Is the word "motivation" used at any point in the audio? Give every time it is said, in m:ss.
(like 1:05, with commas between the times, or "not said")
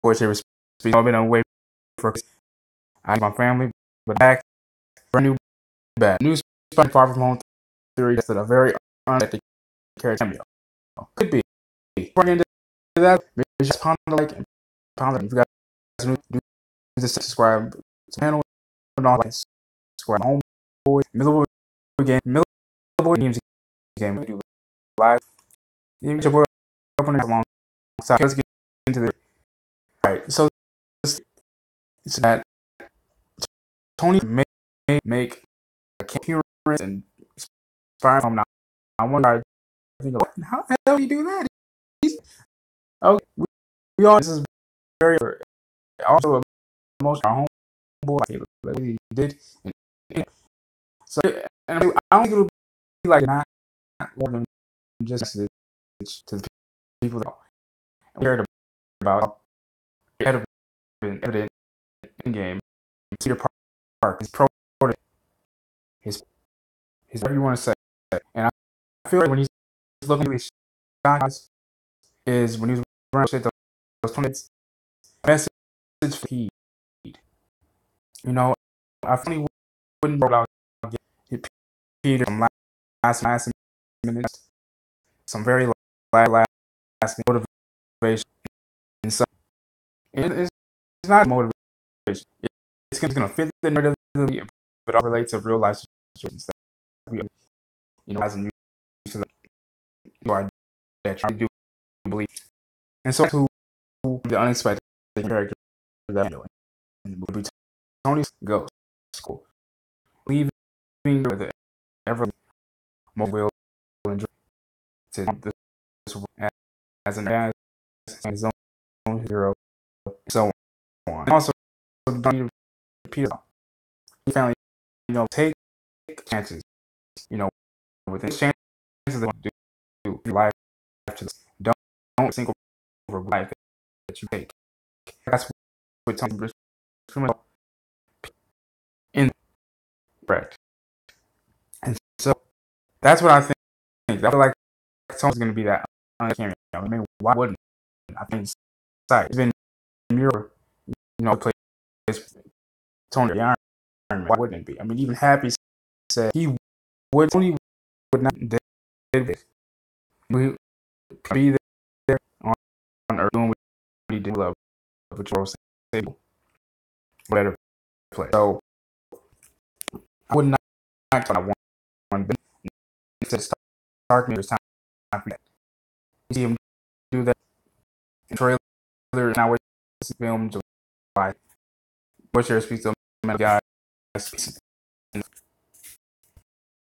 1:27, 1:31.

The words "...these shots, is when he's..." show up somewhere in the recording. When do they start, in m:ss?
1:10.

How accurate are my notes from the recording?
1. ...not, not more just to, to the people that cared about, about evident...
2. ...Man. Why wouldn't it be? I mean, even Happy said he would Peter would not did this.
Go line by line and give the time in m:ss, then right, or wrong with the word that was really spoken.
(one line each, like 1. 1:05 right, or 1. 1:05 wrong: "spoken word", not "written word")
1. 0:53 right
2. 2:34 wrong: "Tony", not "Peter".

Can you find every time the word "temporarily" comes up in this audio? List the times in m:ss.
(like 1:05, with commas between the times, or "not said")
not said.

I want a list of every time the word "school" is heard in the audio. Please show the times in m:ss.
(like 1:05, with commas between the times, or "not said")
1:49.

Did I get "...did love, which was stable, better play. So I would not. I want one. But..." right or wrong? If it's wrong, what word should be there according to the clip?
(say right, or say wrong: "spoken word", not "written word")
right.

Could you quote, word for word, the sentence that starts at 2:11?
Don't, don't single over life that you take.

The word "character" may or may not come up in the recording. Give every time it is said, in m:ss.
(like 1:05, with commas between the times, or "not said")
0:09, 1:45.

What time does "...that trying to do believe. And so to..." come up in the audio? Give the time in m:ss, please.
1:41.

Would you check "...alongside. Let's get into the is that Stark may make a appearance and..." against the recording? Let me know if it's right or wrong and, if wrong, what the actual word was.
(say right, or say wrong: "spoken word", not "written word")
wrong: "Tony", not "Stark".